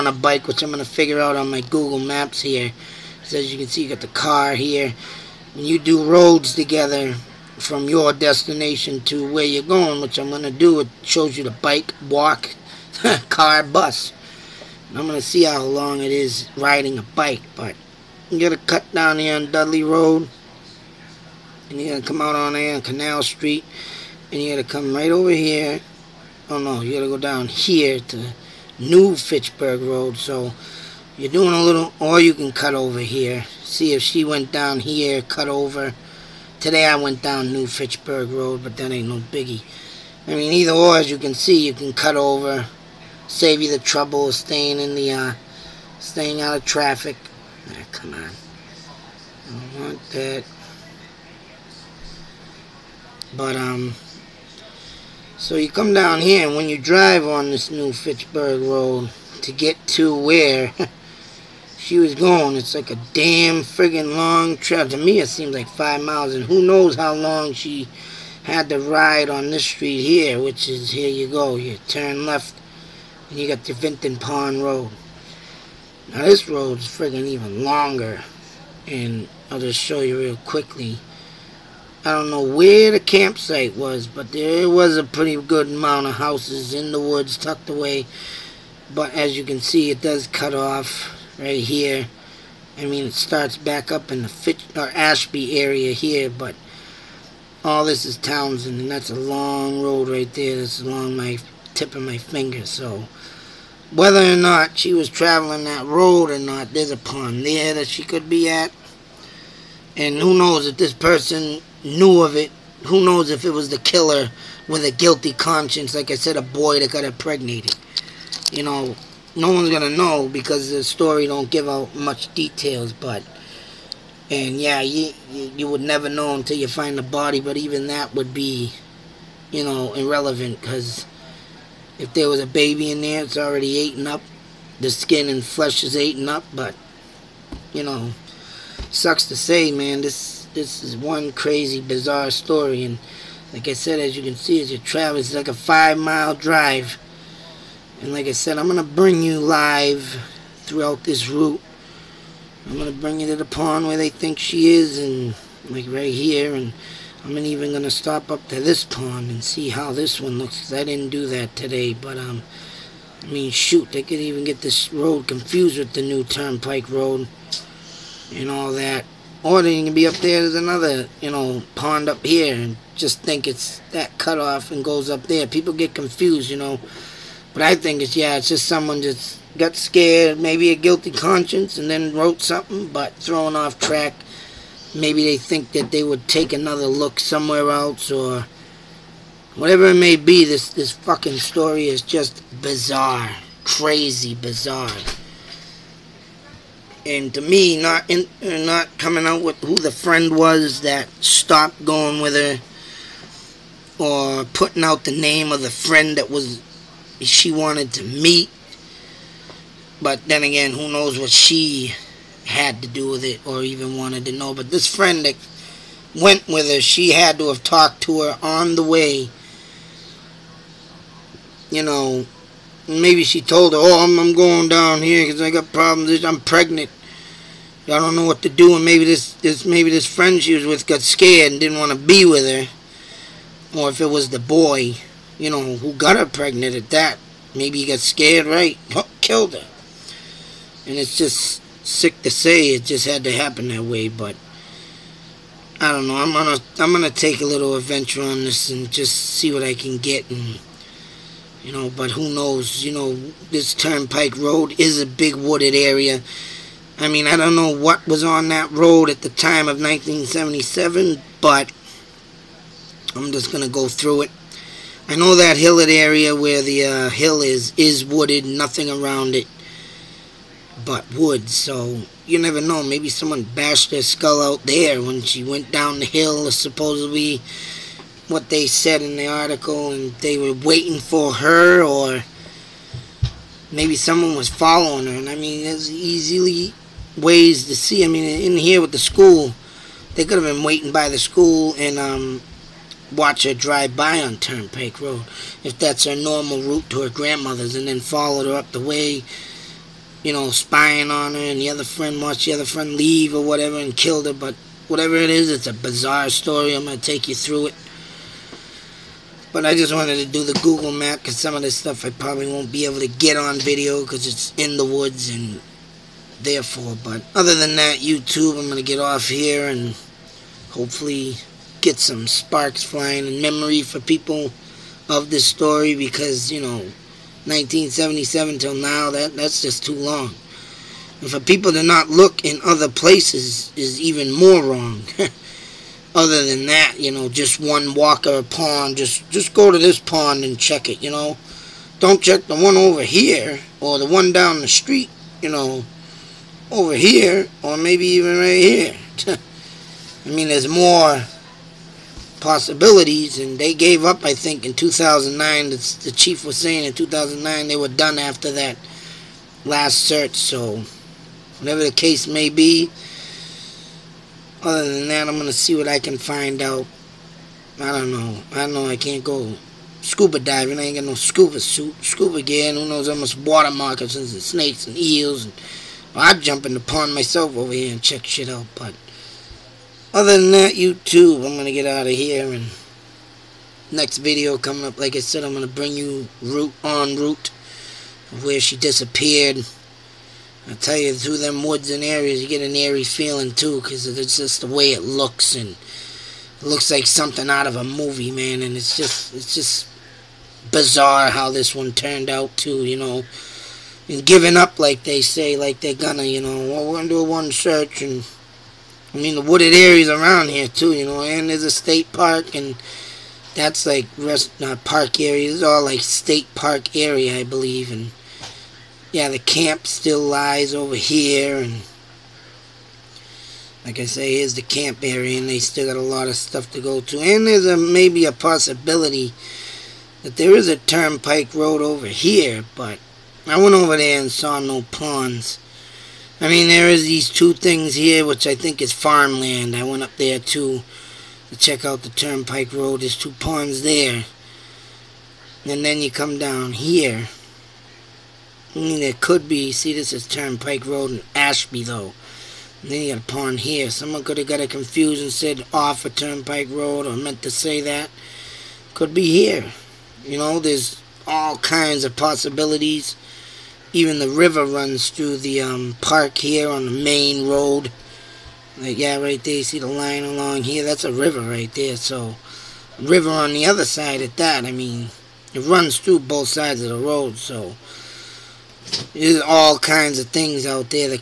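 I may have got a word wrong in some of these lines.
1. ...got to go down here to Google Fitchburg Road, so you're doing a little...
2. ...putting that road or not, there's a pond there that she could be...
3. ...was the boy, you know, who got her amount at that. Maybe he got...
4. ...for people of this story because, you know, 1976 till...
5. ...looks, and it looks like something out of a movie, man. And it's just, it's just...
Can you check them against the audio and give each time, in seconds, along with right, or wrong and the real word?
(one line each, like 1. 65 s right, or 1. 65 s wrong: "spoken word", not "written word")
1. 26 s wrong: "New", not "Google"
2. 105 s wrong: "traveling", not "putting"
3. 234 s wrong: "pregnant", not "amount"
4. 323 s wrong: "1977", not "1976"
5. 395 s right.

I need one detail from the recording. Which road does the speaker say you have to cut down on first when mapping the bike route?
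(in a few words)
Dudley Road.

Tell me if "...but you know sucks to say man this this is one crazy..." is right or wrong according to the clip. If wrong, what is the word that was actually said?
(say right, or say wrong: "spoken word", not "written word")
right.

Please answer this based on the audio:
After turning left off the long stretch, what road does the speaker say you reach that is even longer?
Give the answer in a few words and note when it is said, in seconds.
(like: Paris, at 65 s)
Vinton Pond Road, at 73 s.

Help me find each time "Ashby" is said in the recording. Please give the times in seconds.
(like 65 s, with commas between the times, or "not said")
94 s, 451 s.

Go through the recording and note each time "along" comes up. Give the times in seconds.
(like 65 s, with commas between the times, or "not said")
100 s, 470 s.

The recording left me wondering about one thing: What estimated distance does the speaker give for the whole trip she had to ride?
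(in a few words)
5 miles.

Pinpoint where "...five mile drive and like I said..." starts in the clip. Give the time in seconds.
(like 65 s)
145 s.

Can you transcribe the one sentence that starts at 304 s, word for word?
But whatever it is, it's a bizarre story.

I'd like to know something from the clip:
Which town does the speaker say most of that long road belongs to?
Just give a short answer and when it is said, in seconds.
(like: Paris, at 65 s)
Townsend, at 98 s.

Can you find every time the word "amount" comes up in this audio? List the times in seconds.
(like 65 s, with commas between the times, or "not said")
85 s.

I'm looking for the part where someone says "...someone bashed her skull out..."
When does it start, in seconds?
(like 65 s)
273 s.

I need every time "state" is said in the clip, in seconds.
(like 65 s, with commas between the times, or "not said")
411 s, 415 s.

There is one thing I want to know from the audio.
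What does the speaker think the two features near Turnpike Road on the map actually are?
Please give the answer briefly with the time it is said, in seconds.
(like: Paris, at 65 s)
farmland, at 438 s.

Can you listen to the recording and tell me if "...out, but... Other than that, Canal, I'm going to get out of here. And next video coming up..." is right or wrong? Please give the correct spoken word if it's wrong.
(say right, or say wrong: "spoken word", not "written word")
wrong: "YouTube", not "Canal".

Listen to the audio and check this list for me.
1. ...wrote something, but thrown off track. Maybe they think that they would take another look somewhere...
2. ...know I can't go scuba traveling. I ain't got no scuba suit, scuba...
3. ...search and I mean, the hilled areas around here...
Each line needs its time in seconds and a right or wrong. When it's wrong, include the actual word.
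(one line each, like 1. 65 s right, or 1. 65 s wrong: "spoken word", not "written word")
1. 182 s right
2. 368 s wrong: "diving", not "traveling"
3. 407 s wrong: "wooded", not "hilled".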